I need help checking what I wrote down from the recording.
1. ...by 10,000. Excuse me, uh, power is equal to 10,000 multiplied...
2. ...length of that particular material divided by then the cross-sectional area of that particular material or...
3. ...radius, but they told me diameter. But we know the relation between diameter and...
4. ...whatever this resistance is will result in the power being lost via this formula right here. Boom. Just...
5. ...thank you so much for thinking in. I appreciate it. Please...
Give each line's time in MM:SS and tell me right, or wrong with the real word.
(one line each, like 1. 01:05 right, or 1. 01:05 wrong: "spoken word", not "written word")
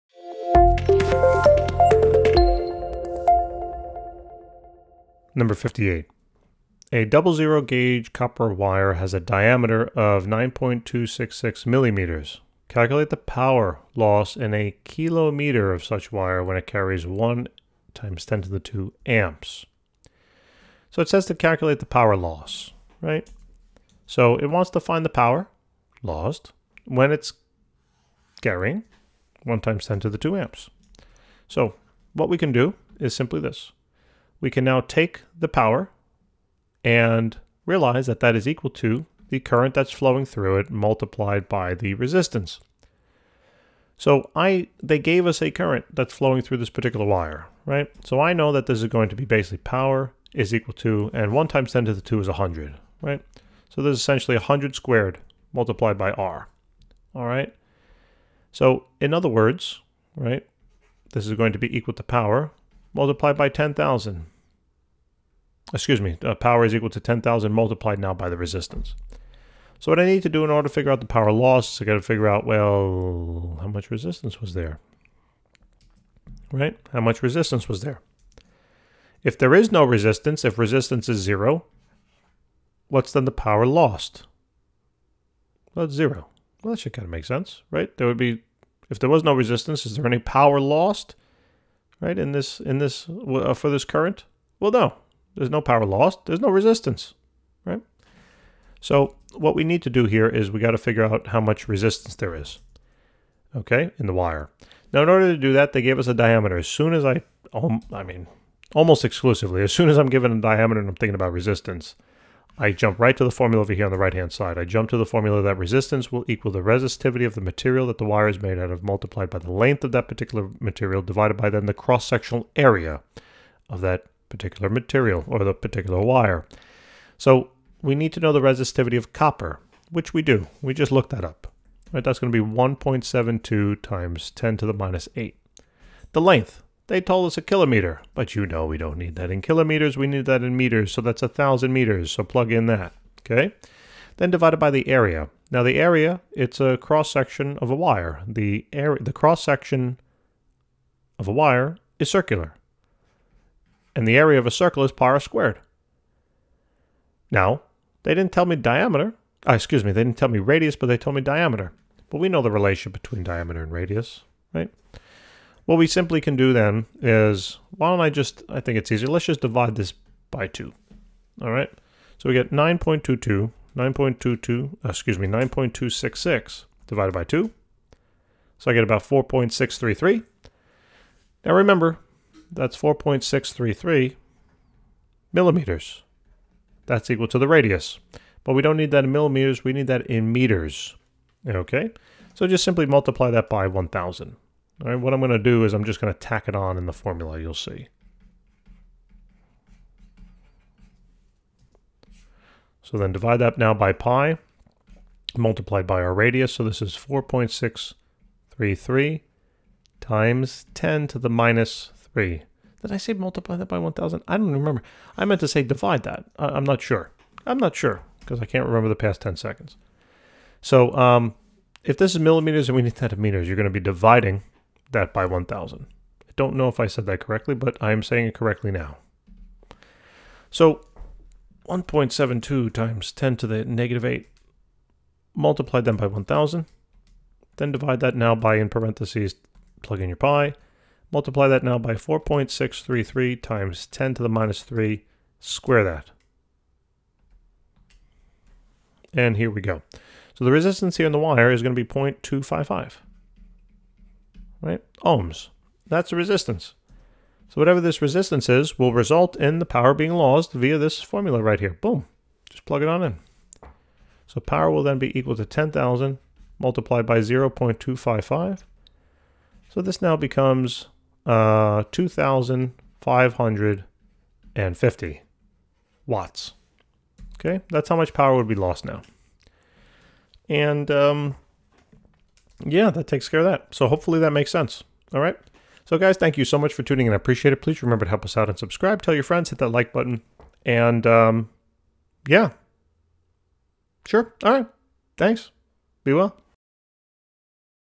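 1. 01:03 right
2. 01:59 right
3. 02:40 right
4. 04:17 right
5. 04:46 wrong: "tuning", not "thinking".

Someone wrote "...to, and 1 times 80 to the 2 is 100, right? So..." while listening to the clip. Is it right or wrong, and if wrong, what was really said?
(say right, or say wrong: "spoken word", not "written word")
wrong: "10", not "80".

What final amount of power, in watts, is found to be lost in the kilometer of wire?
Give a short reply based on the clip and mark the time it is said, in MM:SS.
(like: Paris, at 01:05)
2,550 watts, at 04:31.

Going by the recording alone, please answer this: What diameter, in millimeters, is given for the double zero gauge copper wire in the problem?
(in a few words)
9.266 millimeters.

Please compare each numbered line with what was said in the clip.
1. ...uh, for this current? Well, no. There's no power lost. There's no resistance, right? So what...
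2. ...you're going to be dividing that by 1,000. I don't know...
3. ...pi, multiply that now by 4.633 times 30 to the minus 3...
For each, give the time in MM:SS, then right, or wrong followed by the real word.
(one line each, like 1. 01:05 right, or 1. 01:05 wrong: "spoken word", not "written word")
1. 01:33 right
2. 03:43 right
3. 04:00 wrong: "10", not "30".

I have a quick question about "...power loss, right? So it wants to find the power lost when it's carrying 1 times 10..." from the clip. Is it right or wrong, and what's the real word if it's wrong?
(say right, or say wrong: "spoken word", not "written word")
right.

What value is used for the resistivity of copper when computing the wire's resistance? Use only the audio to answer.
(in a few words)
1.72 times 10 to the minus 8.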